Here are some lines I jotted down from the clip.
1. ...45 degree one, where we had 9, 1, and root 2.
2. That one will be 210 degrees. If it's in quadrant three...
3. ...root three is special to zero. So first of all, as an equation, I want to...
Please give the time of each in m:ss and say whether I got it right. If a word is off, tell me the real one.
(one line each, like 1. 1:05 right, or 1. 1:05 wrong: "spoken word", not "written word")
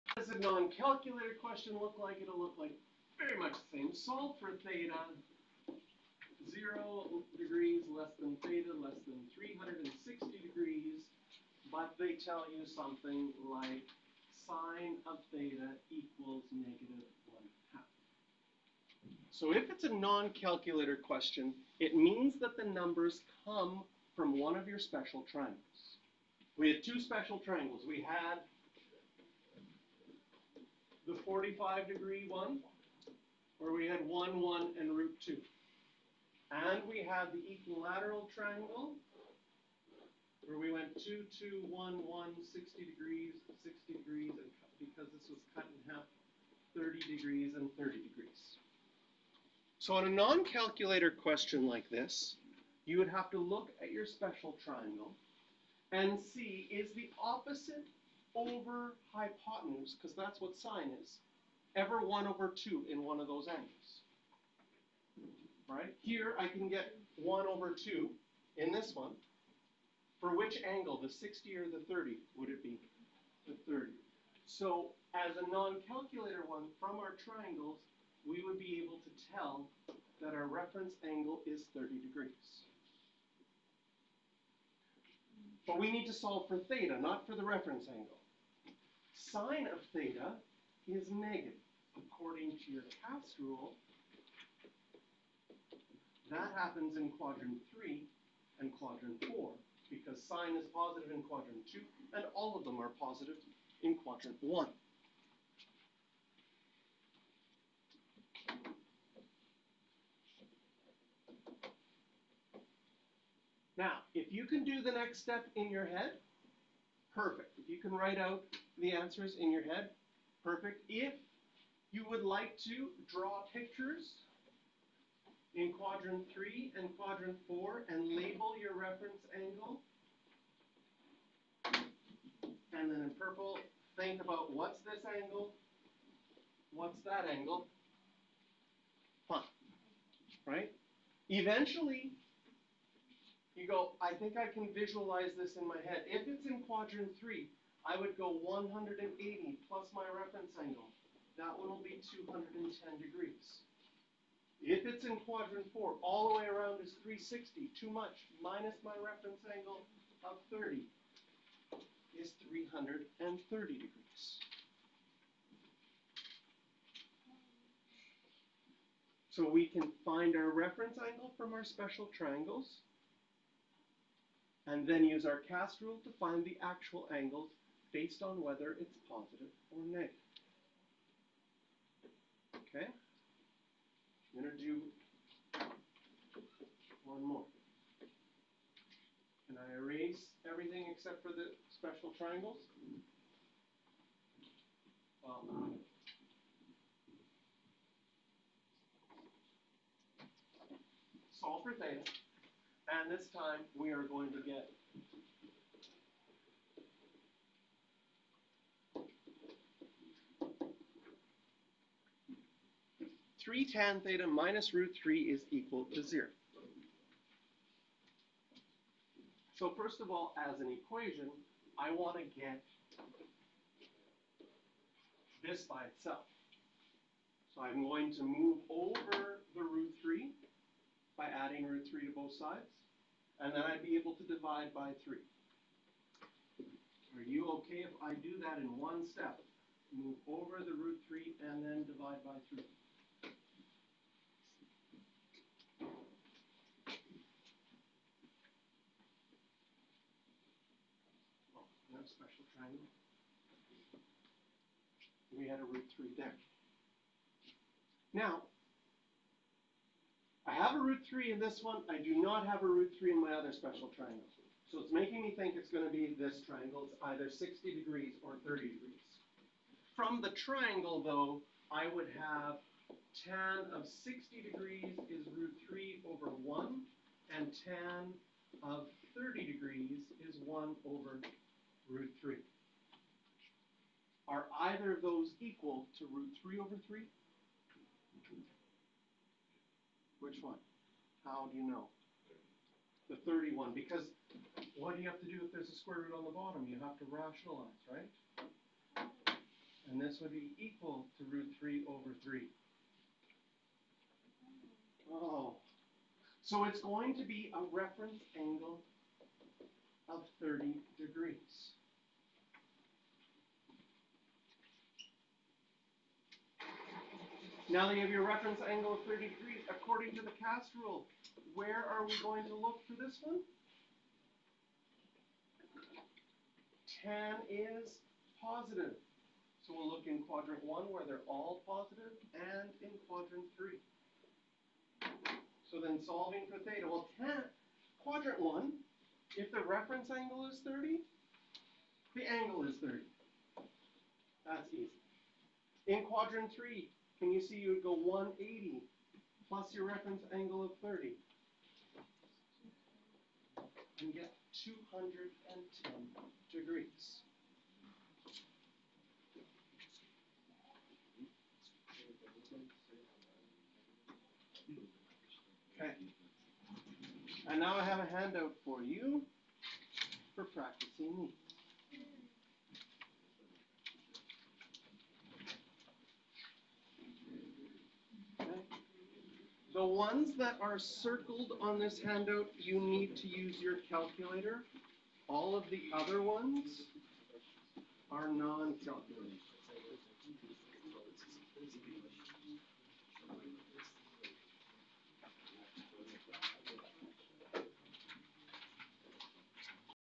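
1. 0:31 wrong: "1", not "9"
2. 2:31 wrong: "four", not "three"
3. 3:34 wrong: "equal", not "special".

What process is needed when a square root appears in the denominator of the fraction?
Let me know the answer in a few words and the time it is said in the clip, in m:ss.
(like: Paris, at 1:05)
rationalize, at 4:57.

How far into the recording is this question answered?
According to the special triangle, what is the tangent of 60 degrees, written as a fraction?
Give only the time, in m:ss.
4:35.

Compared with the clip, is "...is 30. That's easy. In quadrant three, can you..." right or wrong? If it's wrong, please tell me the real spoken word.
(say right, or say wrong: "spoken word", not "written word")
right.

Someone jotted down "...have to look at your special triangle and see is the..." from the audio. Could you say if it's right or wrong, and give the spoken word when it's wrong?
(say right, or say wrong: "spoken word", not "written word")
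right.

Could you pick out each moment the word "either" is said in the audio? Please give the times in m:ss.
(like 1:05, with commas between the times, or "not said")
4:27, 4:44.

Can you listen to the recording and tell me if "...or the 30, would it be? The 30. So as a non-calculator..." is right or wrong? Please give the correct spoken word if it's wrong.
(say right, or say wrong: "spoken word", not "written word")
right.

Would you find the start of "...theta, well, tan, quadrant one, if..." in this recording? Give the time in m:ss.
5:36.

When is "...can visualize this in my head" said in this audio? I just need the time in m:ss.
2:24.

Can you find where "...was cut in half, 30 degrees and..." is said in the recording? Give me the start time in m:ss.
0:45.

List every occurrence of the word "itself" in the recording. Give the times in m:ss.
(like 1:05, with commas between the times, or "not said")
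3:45.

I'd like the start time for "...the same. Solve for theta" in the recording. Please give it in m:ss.
0:03.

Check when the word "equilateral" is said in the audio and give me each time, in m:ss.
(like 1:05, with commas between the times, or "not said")
0:37.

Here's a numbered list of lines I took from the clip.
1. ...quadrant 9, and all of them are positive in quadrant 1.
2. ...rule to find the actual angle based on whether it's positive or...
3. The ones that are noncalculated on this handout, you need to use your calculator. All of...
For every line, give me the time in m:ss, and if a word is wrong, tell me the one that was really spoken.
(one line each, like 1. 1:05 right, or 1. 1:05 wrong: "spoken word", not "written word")
1. 1:41 wrong: "2", not "9"
2. 2:55 right
3. 6:19 wrong: "circled", not "noncalculated".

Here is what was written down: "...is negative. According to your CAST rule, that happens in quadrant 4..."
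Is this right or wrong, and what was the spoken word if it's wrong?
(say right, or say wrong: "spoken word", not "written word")
wrong: "3", not "4".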